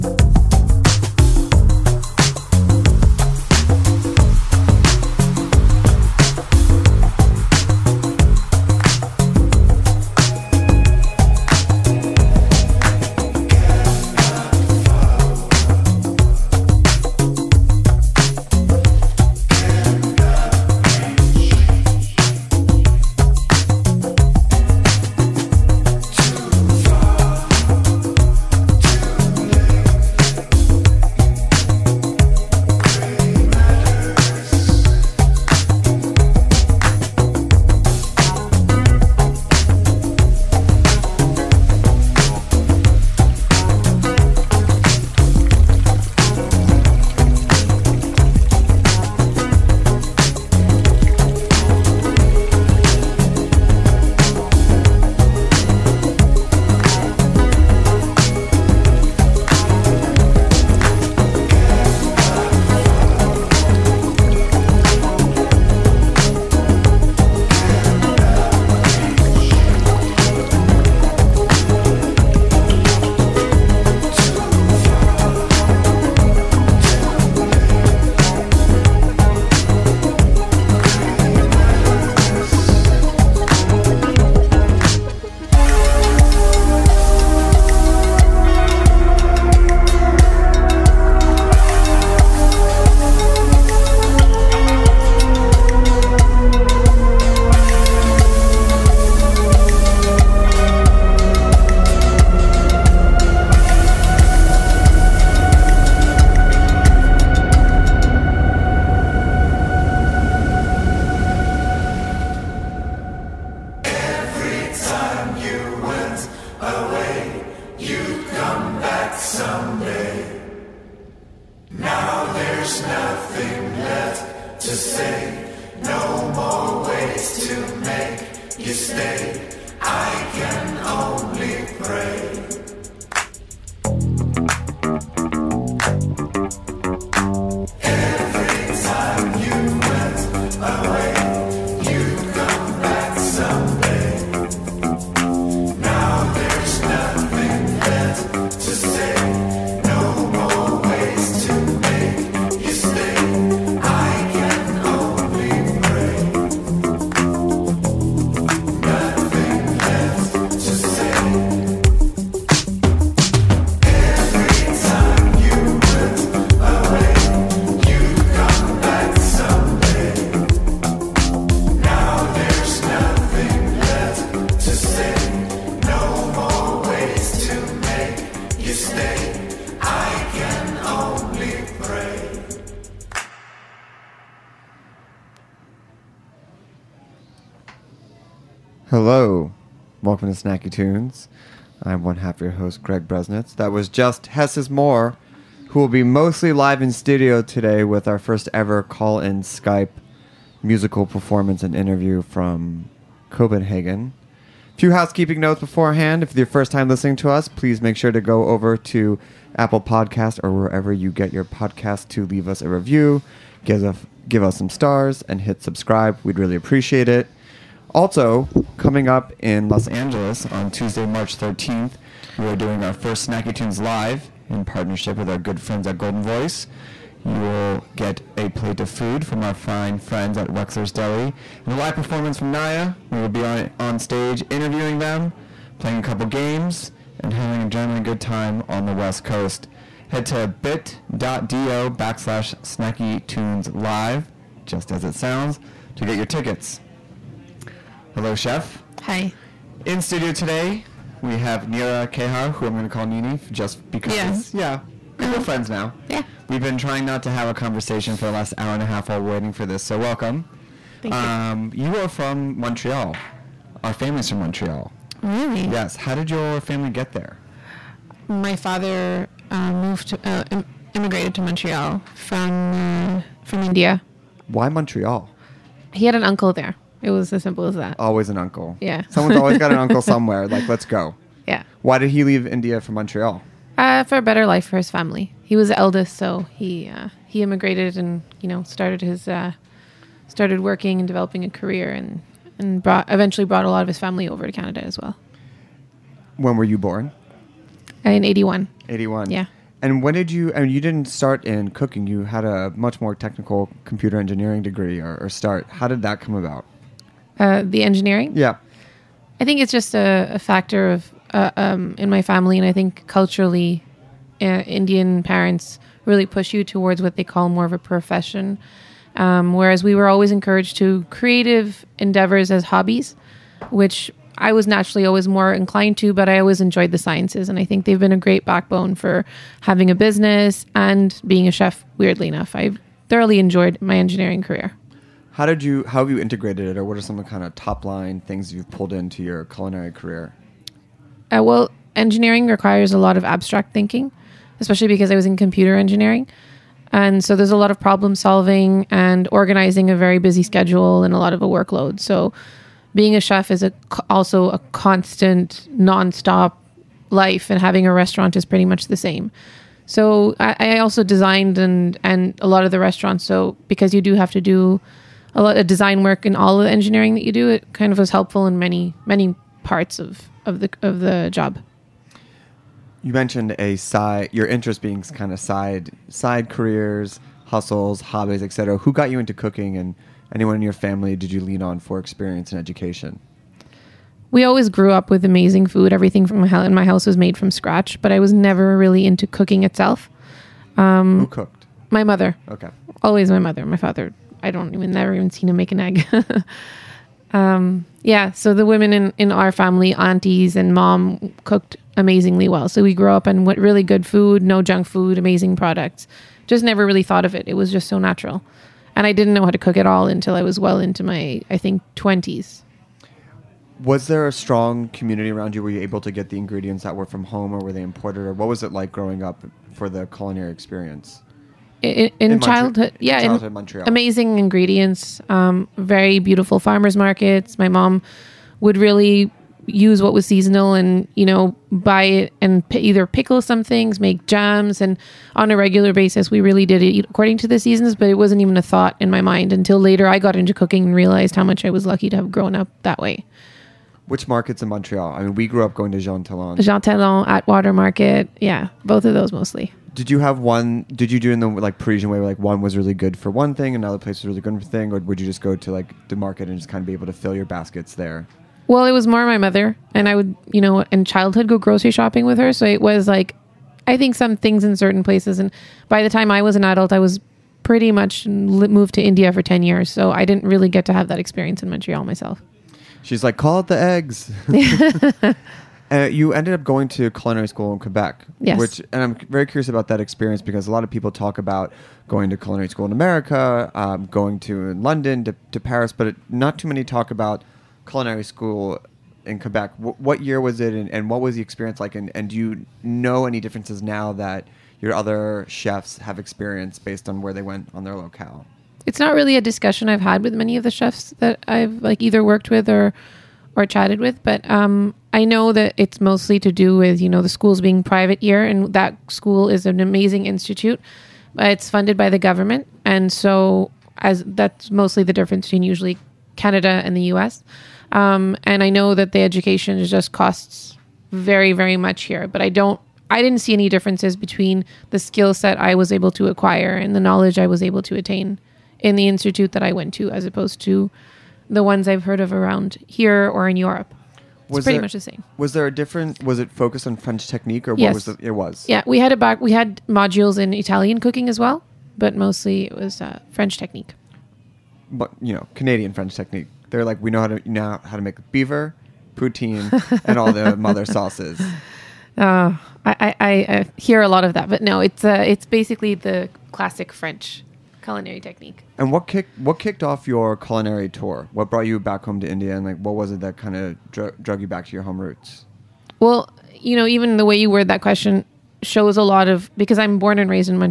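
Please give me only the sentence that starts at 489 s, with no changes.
W- what year was it, and, and, what was the experience like?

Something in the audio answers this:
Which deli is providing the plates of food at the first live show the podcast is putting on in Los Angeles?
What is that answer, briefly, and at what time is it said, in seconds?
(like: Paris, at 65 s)
Wexler's Deli, at 230 s.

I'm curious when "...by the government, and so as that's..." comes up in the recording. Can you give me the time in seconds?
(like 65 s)
511 s.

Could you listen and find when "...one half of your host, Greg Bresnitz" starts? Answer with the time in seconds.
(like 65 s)
192 s.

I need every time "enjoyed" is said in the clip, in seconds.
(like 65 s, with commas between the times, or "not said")
326 s, 333 s.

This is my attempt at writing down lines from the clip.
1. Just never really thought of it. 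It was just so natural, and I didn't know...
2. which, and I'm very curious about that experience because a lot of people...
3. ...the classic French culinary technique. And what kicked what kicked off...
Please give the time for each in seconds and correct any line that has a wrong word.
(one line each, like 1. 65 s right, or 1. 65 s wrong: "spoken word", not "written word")
1. 406 s right
2. 478 s right
3. 555 s right.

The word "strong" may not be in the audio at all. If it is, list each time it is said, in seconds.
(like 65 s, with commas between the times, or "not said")
414 s.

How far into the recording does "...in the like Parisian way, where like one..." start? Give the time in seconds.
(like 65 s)
451 s.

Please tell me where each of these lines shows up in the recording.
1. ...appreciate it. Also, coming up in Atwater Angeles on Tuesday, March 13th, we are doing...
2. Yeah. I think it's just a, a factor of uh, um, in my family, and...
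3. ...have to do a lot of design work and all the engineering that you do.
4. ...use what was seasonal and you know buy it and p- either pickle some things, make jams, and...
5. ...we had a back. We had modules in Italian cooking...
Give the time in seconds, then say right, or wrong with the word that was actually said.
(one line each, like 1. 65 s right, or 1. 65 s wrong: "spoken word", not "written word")
1. 216 s wrong: "Los", not "Atwater"
2. 308 s right
3. 364 s right
4. 429 s right
5. 538 s right.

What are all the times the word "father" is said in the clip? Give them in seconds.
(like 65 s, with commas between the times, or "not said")
268 s, 393 s.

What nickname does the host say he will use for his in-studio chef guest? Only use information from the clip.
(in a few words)
Nini.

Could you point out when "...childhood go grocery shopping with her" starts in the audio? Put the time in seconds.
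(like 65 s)
461 s.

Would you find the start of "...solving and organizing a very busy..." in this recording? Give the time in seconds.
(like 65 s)
348 s.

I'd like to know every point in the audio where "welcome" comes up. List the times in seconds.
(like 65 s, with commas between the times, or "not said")
190 s, 259 s.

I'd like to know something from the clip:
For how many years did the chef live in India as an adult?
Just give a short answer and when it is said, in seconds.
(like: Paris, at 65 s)
10, at 469 s.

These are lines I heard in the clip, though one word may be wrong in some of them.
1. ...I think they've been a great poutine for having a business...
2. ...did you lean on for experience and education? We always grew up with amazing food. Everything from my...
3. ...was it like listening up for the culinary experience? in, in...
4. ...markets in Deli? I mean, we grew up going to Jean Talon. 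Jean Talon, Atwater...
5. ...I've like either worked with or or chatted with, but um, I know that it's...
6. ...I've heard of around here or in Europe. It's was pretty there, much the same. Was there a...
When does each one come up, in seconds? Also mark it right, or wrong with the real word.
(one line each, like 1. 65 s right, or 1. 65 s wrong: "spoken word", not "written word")
1. 327 s wrong: "backbone", not "poutine"
2. 381 s right
3. 418 s wrong: "growing", not "listening"
4. 444 s wrong: "Montreal", not "Deli"
5. 501 s right
6. 531 s right.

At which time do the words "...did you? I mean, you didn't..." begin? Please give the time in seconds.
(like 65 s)
300 s.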